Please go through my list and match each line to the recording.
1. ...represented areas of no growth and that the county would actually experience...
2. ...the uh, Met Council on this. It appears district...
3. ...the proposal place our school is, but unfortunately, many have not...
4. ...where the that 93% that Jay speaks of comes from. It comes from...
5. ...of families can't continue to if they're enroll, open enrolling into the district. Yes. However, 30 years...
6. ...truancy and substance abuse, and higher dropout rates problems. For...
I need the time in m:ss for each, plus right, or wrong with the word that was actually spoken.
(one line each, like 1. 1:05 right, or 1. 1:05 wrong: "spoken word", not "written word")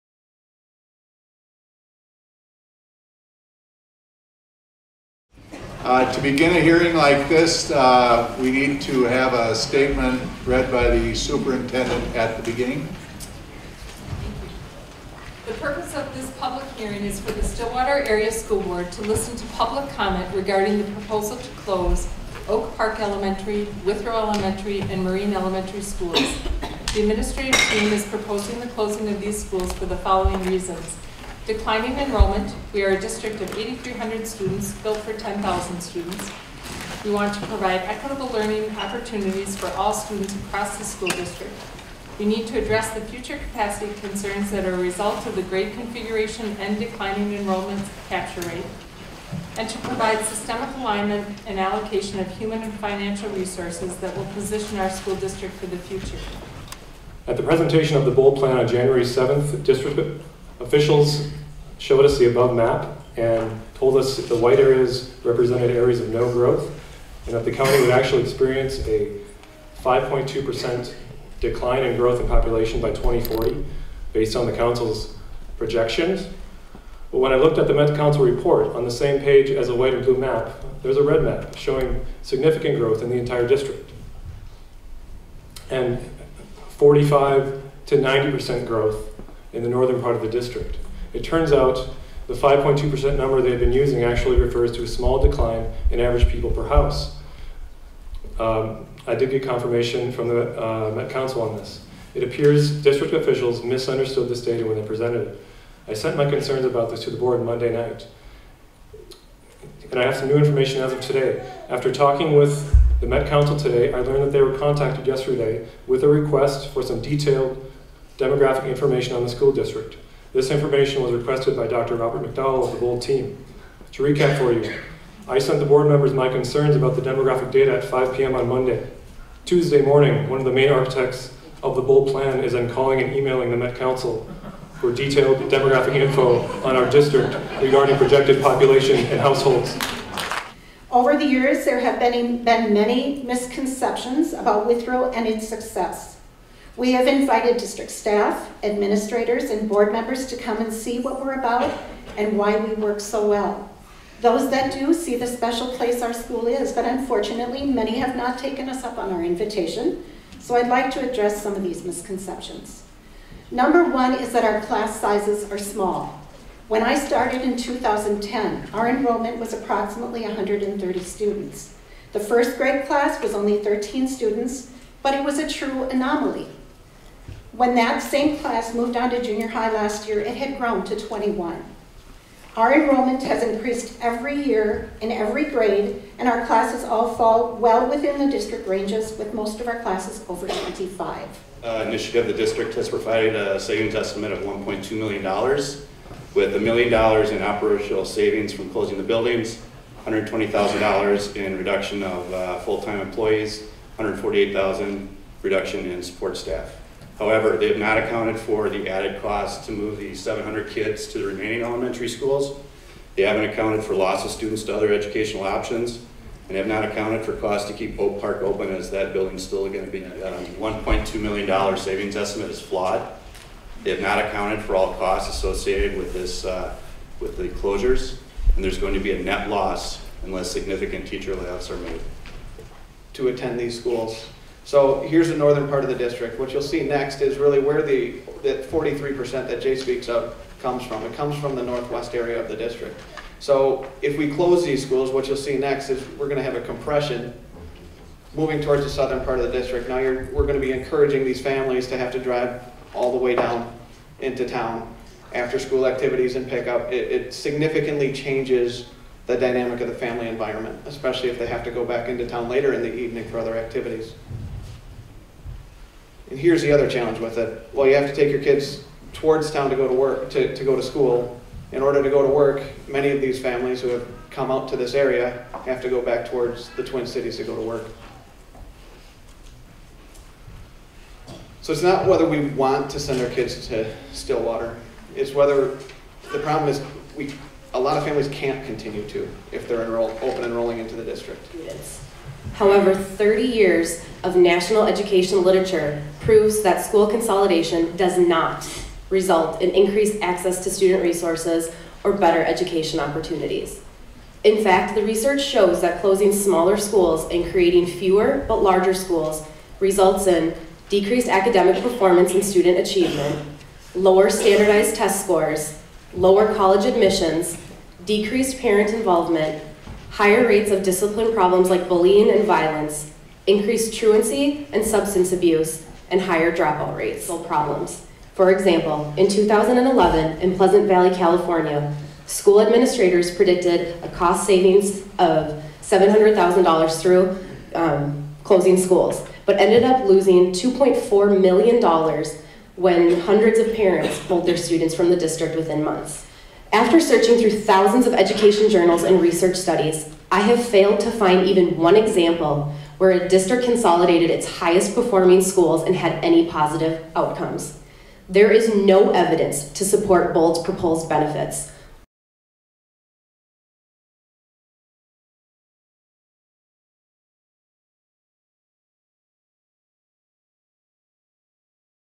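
1. 1:05 right
2. 1:40 right
3. 2:35 wrong: "special", not "proposal"
4. 3:57 wrong: "43", not "93"
5. 4:47 right
6. 5:23 right.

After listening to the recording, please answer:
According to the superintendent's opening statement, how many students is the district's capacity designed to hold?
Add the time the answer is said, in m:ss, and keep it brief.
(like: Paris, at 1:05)
10,000, at 0:35.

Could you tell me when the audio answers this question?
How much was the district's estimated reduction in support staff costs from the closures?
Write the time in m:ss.
3:23.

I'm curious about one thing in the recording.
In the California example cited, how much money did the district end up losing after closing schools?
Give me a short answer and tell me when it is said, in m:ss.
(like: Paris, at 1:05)
$2.4 million, at 5:40.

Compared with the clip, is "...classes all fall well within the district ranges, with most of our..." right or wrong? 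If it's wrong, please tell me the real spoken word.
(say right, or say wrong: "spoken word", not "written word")
right.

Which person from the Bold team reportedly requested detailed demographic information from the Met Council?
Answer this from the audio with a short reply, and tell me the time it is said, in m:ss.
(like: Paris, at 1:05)
Dr. Robert McDowell, at 2:01.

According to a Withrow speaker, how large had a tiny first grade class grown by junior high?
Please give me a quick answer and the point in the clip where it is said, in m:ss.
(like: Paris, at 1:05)
21, at 3:00.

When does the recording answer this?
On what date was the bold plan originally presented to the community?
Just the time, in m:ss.
0:58.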